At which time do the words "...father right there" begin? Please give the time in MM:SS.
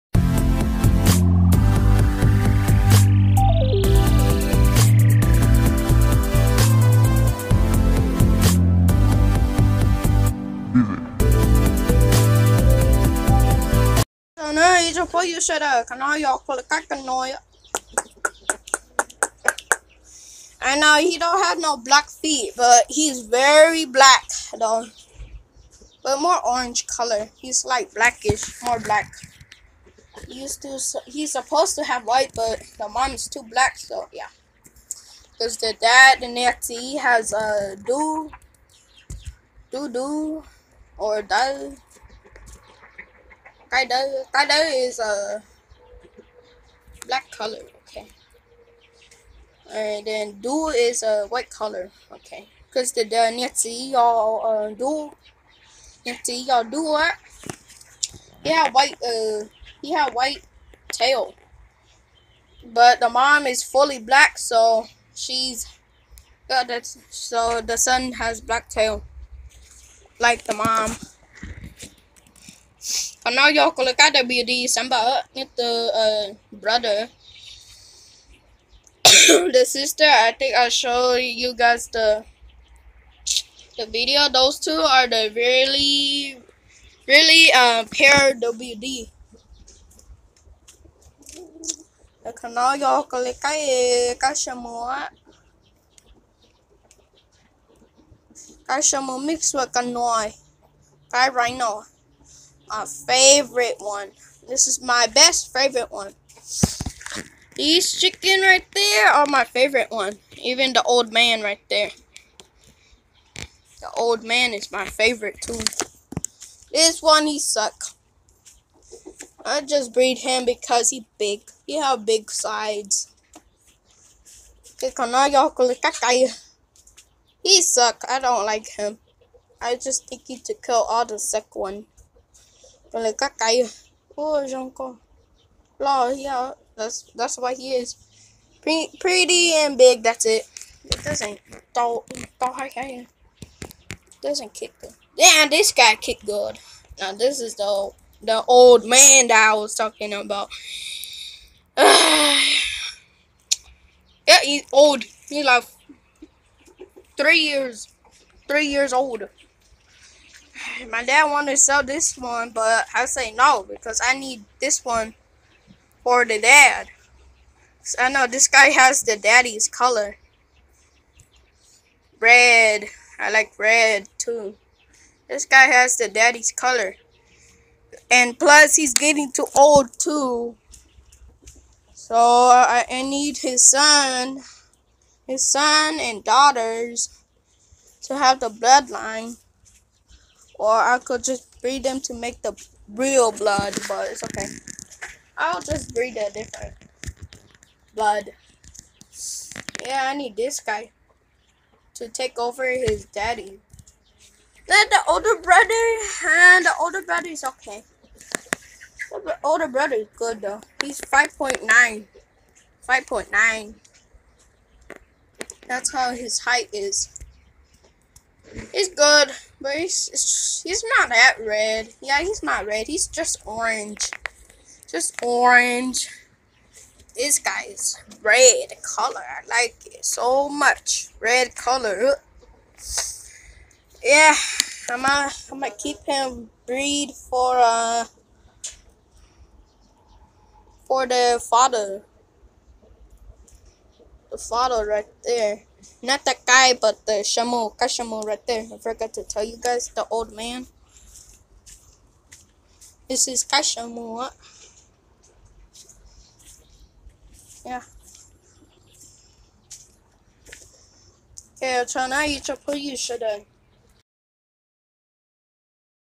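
04:04.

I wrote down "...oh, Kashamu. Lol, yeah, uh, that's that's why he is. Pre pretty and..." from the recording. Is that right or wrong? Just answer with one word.
wrong.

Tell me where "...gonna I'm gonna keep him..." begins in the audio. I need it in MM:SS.
03:55.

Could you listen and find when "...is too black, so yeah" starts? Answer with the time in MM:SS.
00:33.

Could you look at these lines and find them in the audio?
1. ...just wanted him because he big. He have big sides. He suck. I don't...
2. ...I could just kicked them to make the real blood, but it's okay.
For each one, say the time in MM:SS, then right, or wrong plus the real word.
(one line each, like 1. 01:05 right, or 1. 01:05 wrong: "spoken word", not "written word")
1. 01:59 wrong: "breed", not "wanted"
2. 03:10 wrong: "breed", not "kicked".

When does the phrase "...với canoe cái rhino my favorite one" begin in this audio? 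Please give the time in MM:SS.
01:39.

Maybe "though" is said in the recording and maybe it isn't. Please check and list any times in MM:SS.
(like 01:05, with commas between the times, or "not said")
00:24, 03:30.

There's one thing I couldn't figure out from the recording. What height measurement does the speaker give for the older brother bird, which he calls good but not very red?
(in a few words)
5.9.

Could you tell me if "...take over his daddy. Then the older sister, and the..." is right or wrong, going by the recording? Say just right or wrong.
wrong.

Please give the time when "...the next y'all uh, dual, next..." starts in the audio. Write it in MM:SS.
00:53.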